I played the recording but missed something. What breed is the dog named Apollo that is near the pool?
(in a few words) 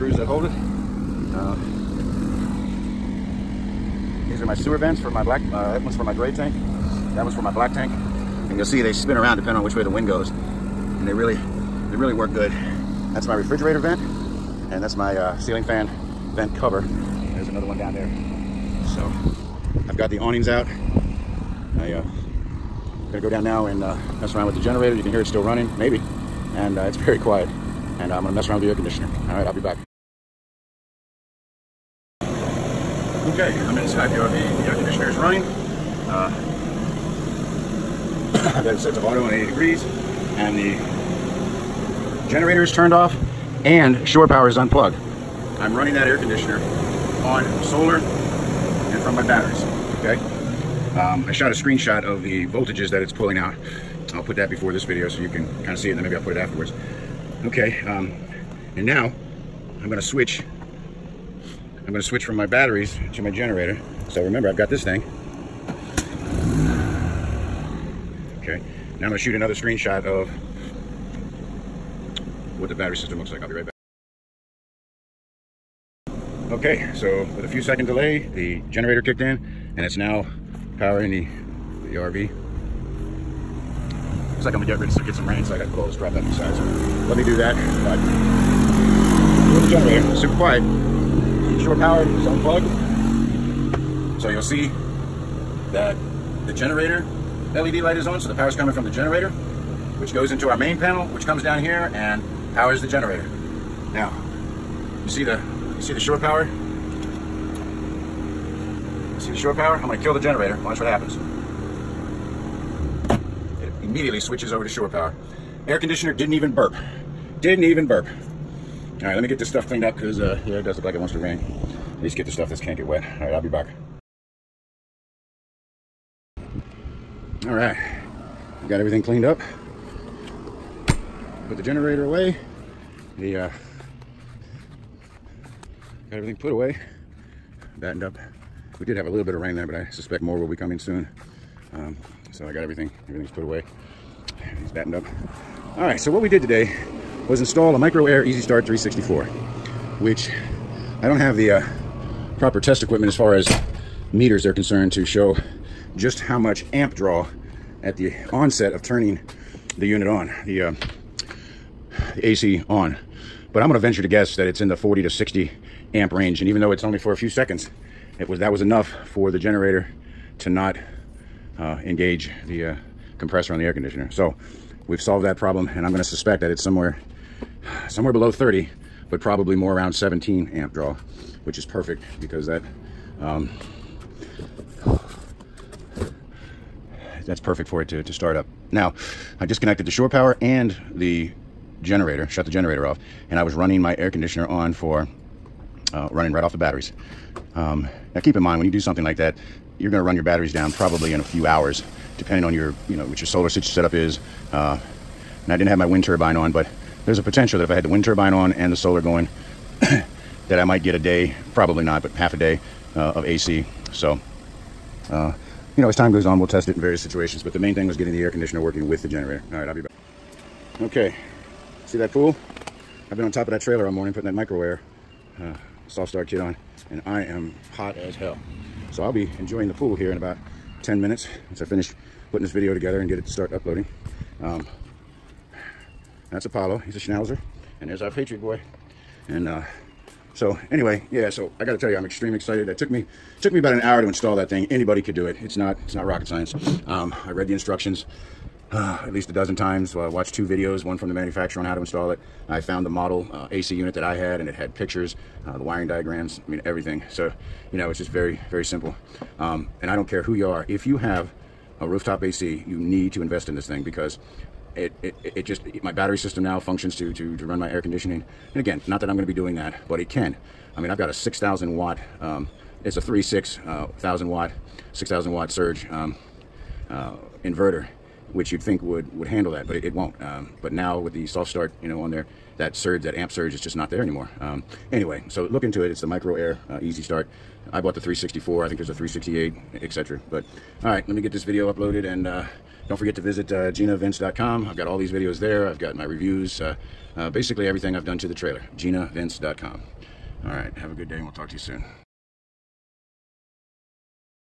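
Schnauzer.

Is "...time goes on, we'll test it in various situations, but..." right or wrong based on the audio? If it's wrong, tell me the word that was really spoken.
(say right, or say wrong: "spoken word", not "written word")
right.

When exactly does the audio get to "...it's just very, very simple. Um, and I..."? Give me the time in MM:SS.
04:17.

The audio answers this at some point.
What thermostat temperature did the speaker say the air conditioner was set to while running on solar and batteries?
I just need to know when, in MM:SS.
00:39.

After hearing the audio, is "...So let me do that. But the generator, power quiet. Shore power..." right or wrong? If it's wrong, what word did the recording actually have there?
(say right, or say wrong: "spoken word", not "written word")
wrong: "super", not "power".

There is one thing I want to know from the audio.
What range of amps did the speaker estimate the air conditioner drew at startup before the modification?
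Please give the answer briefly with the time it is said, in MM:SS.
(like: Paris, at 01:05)
40 to 60 amps, at 02:44.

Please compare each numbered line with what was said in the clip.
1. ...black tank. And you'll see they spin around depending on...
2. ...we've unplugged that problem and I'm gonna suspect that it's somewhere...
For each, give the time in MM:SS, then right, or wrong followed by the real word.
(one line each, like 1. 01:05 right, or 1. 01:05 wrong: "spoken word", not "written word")
1. 00:07 right
2. 02:54 wrong: "solved", not "unplugged".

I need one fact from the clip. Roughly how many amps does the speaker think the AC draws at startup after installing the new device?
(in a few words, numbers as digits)
17.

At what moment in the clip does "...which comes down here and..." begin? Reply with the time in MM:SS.
01:41.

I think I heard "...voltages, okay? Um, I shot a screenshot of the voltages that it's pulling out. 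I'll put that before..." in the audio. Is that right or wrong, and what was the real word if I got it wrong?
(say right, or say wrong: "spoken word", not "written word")
wrong: "batteries", not "voltages".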